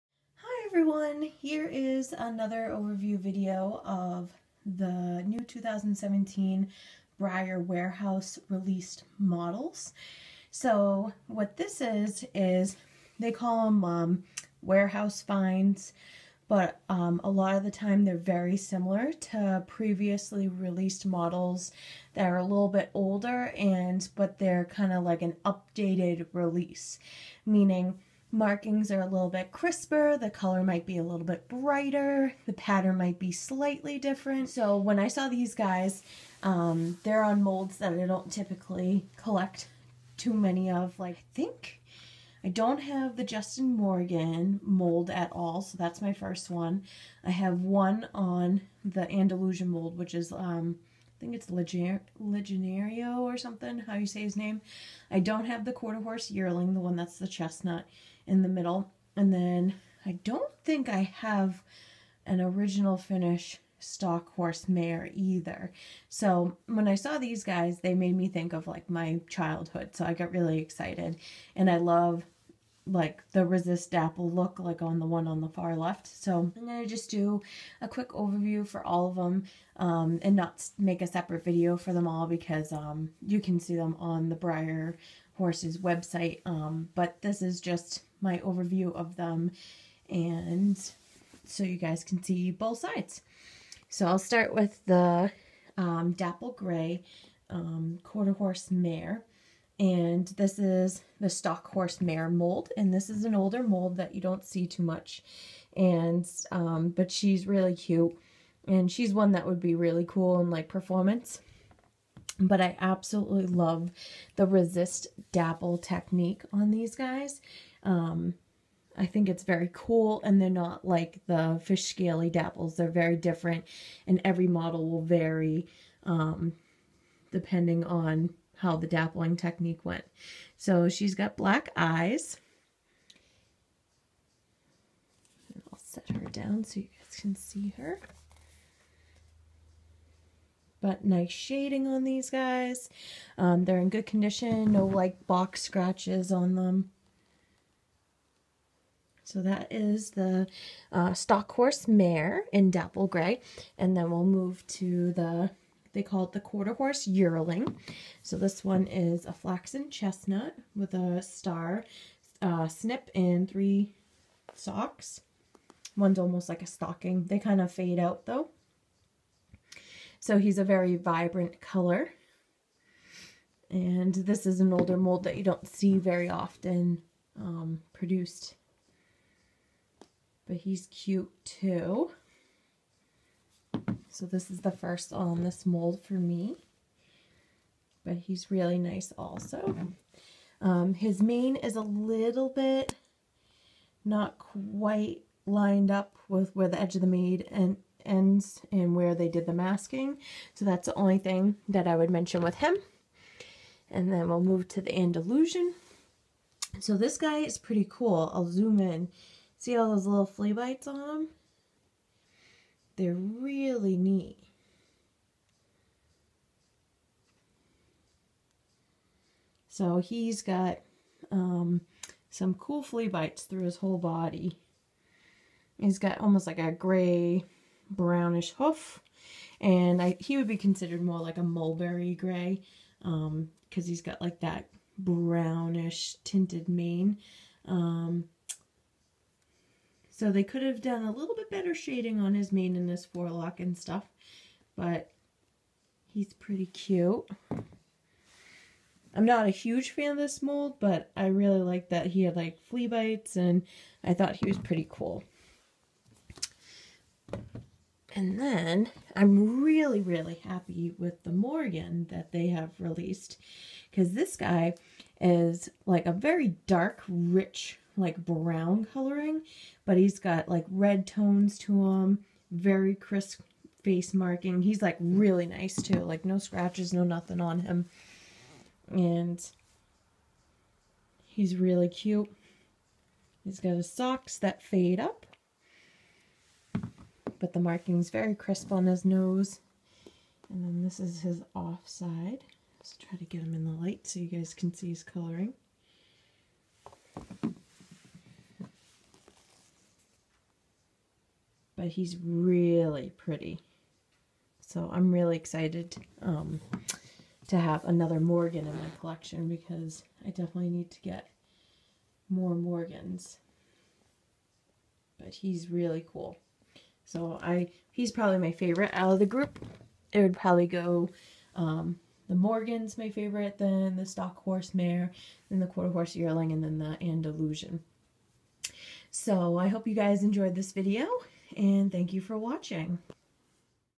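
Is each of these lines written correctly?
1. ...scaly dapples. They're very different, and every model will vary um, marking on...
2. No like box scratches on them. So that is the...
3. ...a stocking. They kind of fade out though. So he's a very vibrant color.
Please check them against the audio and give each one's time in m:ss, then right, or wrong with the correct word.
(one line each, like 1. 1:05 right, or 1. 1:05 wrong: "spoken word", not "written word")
1. 2:01 wrong: "depending", not "marking"
2. 2:24 right
3. 2:46 right.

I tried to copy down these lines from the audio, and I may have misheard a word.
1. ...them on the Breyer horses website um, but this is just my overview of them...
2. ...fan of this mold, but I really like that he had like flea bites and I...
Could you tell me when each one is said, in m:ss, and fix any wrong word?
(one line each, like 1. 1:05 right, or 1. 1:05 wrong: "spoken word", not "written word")
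1. 1:23 right
2. 4:09 right.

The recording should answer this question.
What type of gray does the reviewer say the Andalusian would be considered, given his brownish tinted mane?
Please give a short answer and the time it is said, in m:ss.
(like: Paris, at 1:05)
Mulberry gray, at 3:51.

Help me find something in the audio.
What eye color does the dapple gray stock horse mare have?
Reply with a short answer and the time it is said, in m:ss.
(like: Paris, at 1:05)
Black, at 2:11.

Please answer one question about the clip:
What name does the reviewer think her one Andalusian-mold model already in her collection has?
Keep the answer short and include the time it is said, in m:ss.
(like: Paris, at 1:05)
Legionario, at 0:51.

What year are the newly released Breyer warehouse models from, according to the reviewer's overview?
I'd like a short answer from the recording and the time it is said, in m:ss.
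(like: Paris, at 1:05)
2017, at 0:05.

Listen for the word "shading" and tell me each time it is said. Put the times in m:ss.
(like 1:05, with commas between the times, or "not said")
2:21, 4:01.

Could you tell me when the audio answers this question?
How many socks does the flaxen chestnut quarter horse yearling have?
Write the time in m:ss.
2:43.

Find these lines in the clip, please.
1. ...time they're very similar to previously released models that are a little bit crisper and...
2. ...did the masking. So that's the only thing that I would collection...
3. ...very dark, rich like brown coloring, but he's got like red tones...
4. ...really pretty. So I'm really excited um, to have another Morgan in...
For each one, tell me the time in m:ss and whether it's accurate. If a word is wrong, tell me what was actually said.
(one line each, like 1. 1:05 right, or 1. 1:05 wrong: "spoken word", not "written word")
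1. 0:17 wrong: "older", not "crisper"
2. 3:19 wrong: "mention", not "collection"
3. 4:26 right
4. 5:02 right.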